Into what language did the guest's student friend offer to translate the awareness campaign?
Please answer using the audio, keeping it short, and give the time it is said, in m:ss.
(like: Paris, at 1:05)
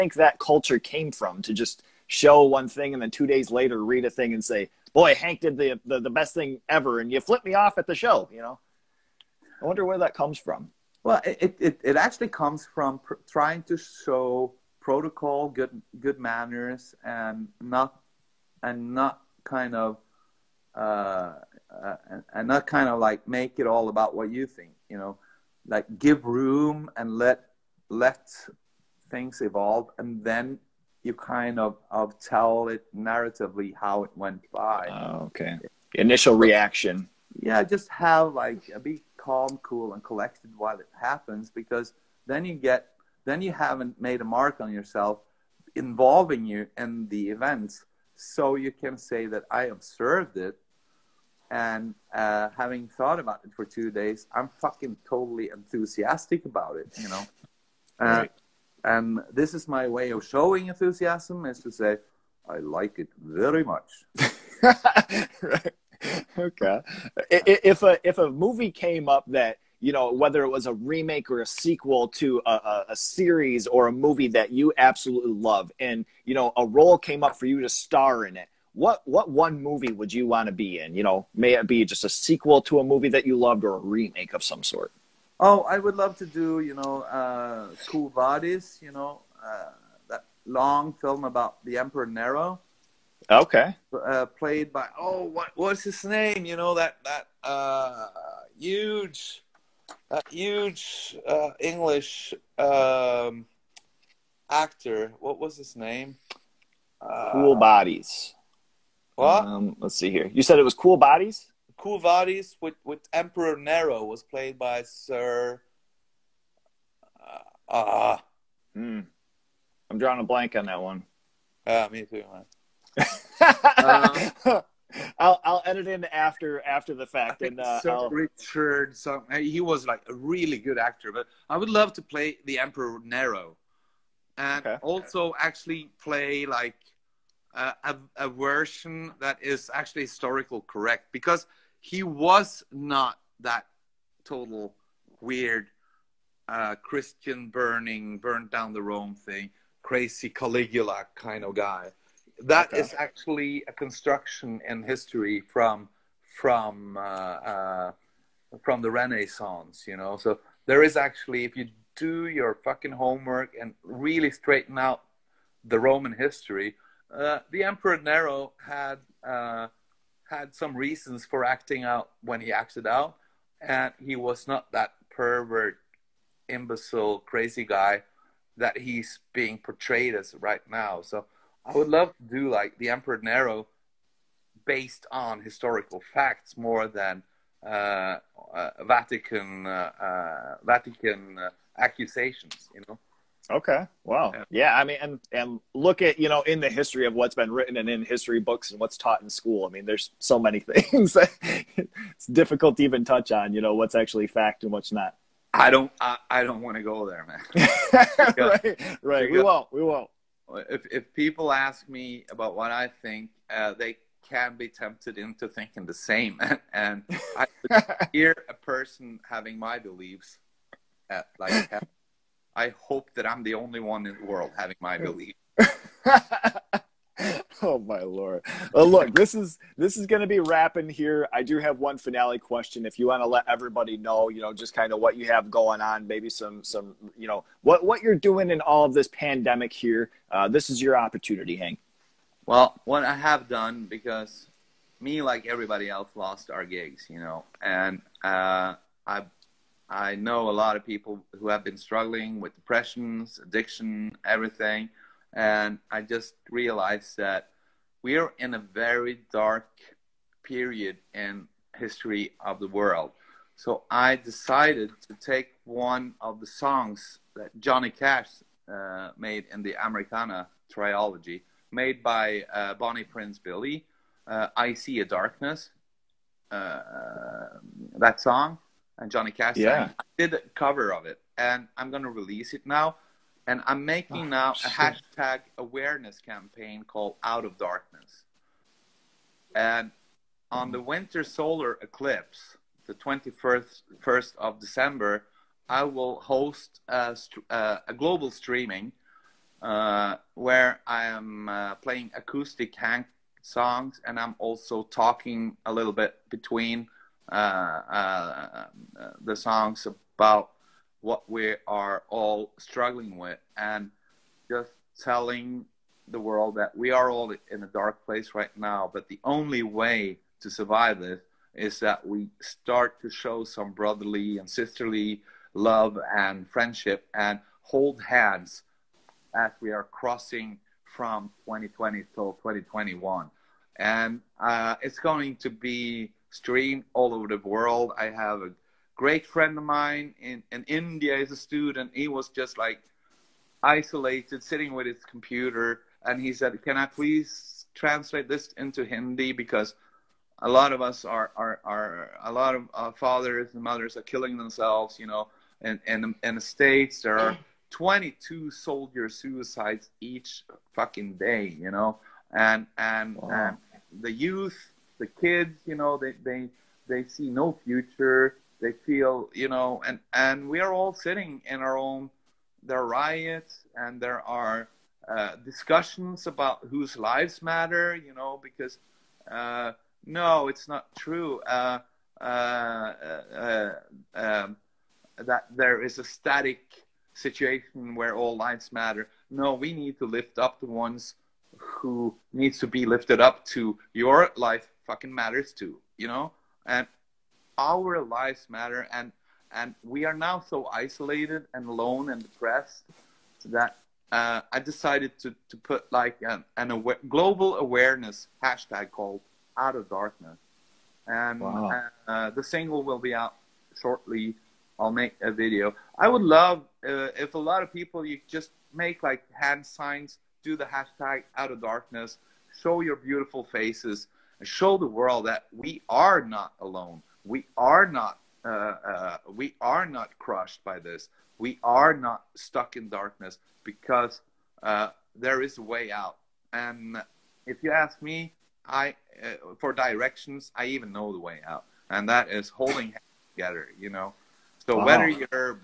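Hindi, at 5:48.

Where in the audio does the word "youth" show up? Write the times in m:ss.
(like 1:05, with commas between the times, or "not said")
6:04.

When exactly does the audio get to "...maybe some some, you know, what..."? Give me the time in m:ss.
3:56.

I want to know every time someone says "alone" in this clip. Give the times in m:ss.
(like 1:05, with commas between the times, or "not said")
6:41, 7:06.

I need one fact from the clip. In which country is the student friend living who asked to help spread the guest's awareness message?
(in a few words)
India.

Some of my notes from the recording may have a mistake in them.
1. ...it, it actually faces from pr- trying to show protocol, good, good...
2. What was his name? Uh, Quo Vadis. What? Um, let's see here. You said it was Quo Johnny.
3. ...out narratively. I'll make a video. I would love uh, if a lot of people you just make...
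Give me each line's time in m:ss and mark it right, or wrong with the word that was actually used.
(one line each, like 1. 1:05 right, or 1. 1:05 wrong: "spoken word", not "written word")
1. 0:11 wrong: "comes", not "faces"
2. 1:45 wrong: "Vadis", not "Johnny"
3. 6:53 wrong: "shortly", not "narratively".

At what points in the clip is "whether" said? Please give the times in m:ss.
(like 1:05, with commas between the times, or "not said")
1:10, 7:24.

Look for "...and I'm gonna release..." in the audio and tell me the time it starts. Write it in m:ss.
4:41.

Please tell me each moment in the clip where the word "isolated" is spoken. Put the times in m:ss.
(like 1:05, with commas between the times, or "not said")
5:43, 6:40.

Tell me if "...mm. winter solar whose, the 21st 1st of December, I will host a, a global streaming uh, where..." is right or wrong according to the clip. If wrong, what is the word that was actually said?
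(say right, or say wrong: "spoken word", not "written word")
wrong: "eclipse", not "whose".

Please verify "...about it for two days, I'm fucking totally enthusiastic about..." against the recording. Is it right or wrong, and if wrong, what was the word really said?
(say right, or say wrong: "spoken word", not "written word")
right.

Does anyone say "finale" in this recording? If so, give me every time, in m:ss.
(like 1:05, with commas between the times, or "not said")
3:51.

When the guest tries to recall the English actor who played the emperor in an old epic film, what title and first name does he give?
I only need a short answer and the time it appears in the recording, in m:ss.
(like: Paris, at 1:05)
Sir Richard, at 2:07.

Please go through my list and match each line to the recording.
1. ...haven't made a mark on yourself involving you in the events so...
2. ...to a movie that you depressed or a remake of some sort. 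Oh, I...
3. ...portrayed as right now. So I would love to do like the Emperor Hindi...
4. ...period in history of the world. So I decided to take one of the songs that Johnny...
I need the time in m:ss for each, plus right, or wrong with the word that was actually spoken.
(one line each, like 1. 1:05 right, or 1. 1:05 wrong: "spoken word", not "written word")
1. 0:43 right
2. 1:22 wrong: "loved", not "depressed"
3. 2:59 wrong: "Nero", not "Hindi"
4. 4:20 right.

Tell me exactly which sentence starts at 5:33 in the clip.
And uh, it's going to be streamed all over the world.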